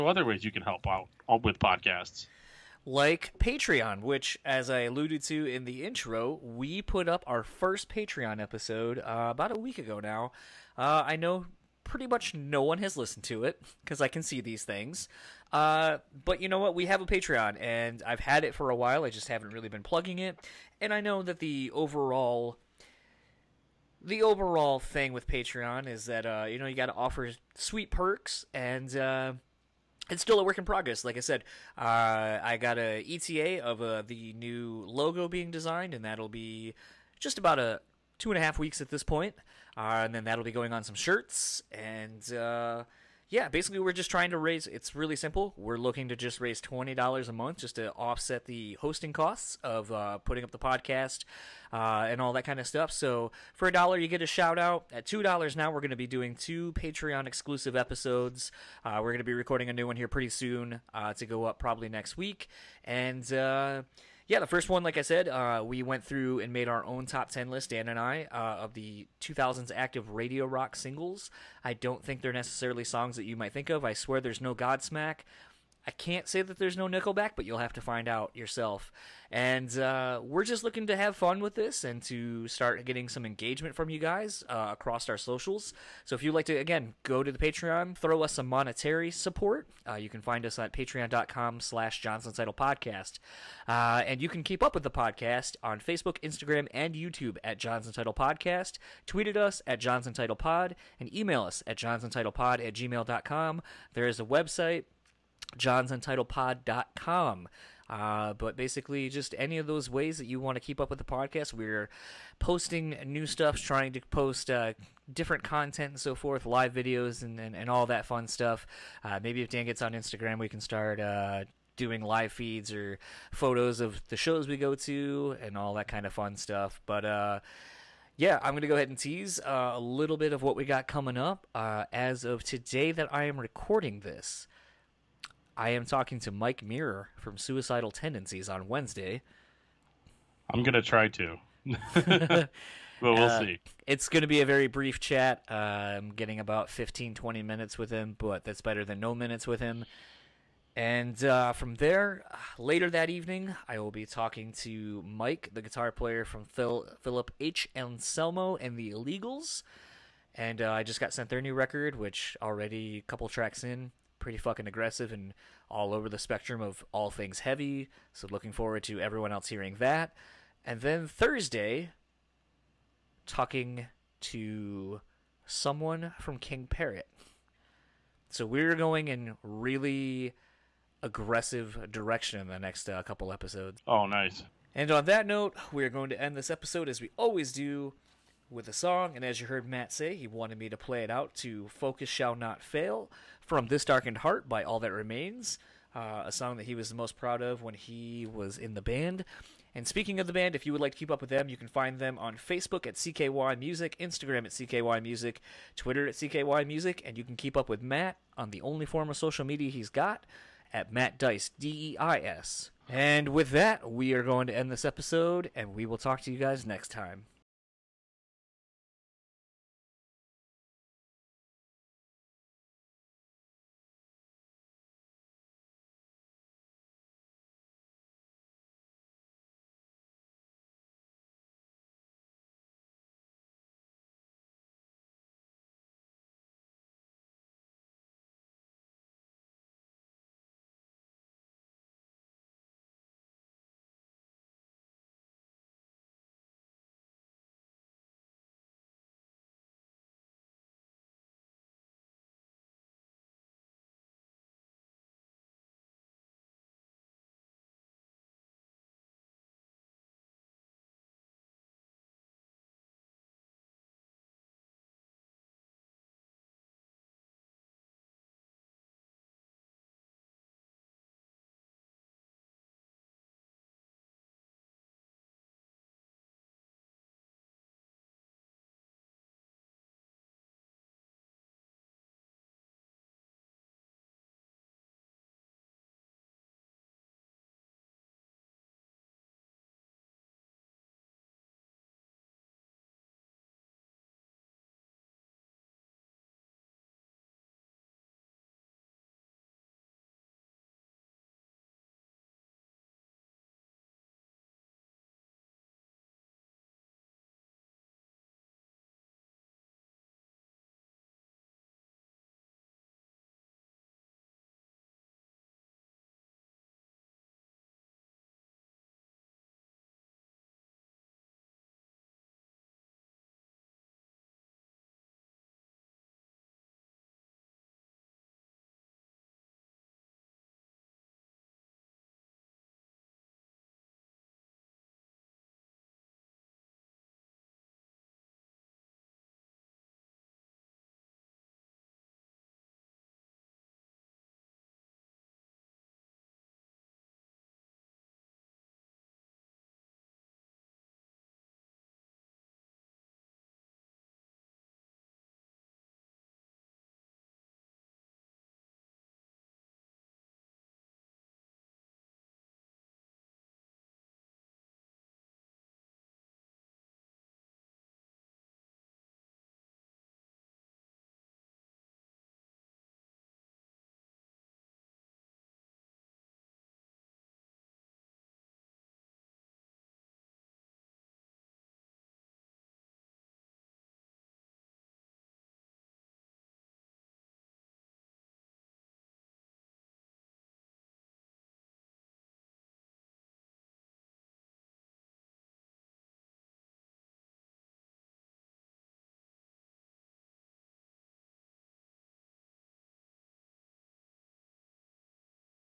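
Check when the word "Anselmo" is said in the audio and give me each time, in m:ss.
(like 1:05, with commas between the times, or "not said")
2:37.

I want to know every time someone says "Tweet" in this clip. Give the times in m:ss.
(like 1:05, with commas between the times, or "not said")
1:39.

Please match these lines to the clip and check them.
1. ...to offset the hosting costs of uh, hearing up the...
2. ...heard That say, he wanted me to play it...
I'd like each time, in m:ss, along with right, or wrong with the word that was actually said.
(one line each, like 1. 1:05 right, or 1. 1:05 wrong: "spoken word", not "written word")
1. 0:47 wrong: "putting", not "hearing"
2. 3:09 wrong: "Matt", not "That".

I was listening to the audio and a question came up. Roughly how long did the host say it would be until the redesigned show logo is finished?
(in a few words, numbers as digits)
Two and a half weeks.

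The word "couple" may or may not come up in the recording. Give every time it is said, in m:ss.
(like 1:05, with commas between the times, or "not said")
2:43, 3:03.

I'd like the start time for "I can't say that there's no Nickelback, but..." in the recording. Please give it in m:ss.
1:15.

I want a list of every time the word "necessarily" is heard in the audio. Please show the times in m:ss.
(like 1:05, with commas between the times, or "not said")
1:12.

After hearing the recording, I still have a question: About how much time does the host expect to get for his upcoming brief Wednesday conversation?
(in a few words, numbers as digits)
15-20 minutes.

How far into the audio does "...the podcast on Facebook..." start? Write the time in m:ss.
1:34.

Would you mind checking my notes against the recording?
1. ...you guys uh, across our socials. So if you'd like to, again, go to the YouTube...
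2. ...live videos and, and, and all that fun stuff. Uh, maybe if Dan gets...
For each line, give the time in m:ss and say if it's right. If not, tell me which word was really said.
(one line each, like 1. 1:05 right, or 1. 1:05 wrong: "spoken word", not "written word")
1. 1:23 wrong: "Patreon", not "YouTube"
2. 1:56 right.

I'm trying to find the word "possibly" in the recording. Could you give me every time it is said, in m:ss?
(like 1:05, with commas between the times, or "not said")
not said.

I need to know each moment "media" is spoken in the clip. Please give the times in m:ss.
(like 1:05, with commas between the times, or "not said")
3:29.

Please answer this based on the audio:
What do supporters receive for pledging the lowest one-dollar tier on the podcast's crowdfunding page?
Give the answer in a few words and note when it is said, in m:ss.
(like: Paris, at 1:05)
A shout out, at 0:54.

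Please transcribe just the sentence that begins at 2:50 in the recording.
And then Thursday, talking to someone from King Parrot.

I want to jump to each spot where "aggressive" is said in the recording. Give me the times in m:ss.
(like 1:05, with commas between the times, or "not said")
2:44, 3:01.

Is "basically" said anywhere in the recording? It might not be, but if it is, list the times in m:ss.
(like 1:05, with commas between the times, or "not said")
0:43, 1:48.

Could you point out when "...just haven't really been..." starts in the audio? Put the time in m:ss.
0:19.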